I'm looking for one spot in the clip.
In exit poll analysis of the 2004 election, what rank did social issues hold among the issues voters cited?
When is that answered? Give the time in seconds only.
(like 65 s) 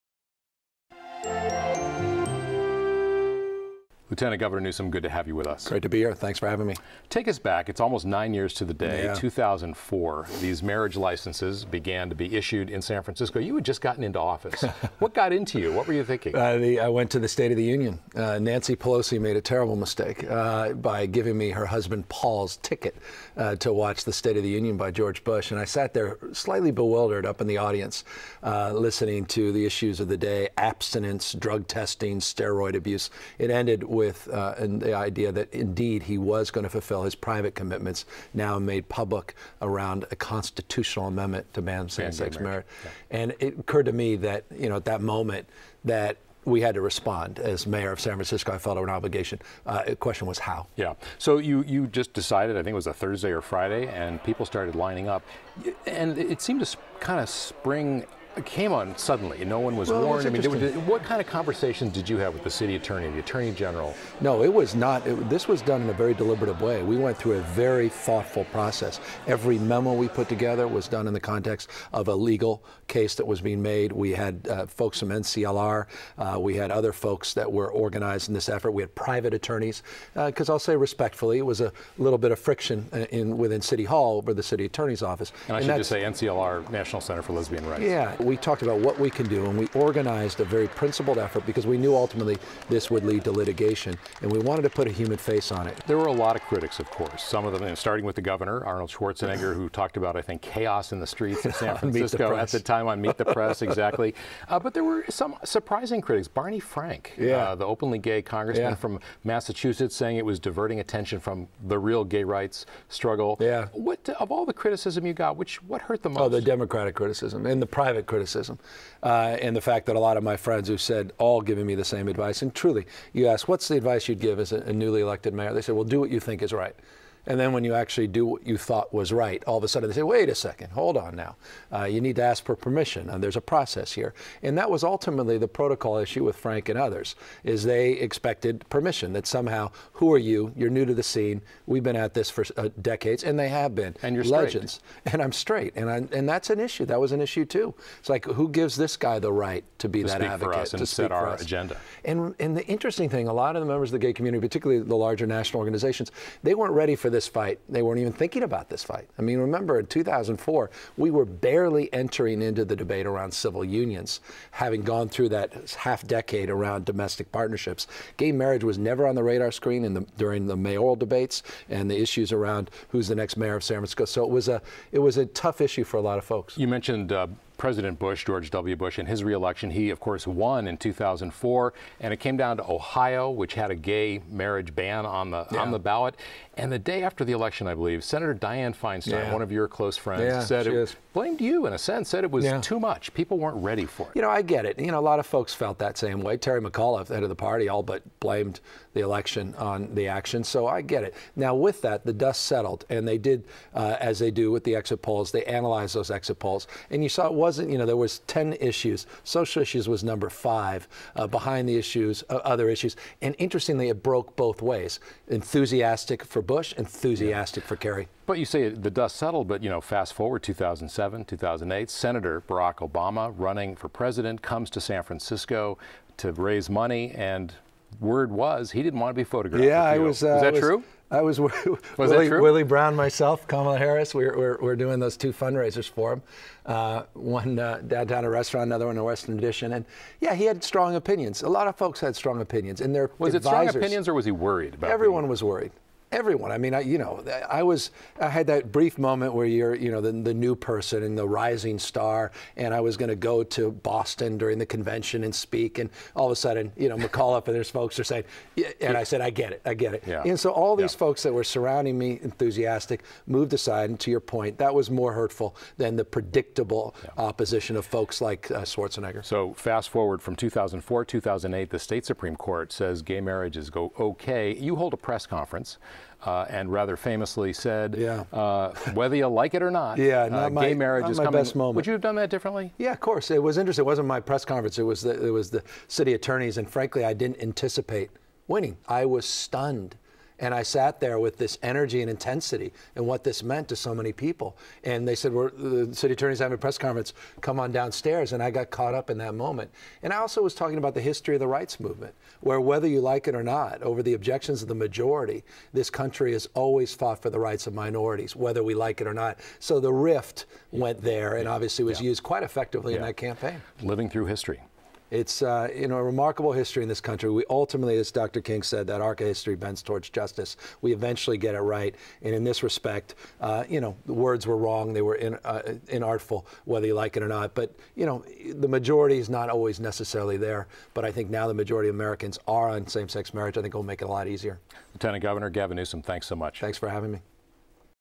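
210 s.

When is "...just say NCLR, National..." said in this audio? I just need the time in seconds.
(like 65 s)
85 s.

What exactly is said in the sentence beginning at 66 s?
We went through a very thoughtful process.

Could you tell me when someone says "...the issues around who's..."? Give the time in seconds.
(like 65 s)
171 s.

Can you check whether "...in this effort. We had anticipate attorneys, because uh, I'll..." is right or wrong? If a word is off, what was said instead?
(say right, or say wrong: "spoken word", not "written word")
wrong: "private", not "anticipate".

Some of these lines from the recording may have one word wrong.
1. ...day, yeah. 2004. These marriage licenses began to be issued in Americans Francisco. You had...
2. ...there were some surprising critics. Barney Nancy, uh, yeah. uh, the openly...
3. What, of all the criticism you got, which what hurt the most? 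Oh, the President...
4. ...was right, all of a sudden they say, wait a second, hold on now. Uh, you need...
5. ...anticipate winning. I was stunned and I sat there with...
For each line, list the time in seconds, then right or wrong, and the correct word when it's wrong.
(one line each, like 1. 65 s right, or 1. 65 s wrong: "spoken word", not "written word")
1. 8 s wrong: "San", not "Americans"
2. 104 s wrong: "Frank", not "Nancy"
3. 113 s wrong: "Democratic", not "President"
4. 128 s right
5. 287 s right.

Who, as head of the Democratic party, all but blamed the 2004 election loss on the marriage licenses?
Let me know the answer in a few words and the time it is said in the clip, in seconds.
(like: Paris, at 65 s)
Terry McAuliffe, at 196 s.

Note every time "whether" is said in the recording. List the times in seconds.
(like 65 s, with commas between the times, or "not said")
278 s, 302 s, 308 s, 326 s.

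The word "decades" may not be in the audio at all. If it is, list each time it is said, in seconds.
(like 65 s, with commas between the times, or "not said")
142 s, 166 s.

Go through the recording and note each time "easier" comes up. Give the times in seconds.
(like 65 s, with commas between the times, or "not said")
334 s.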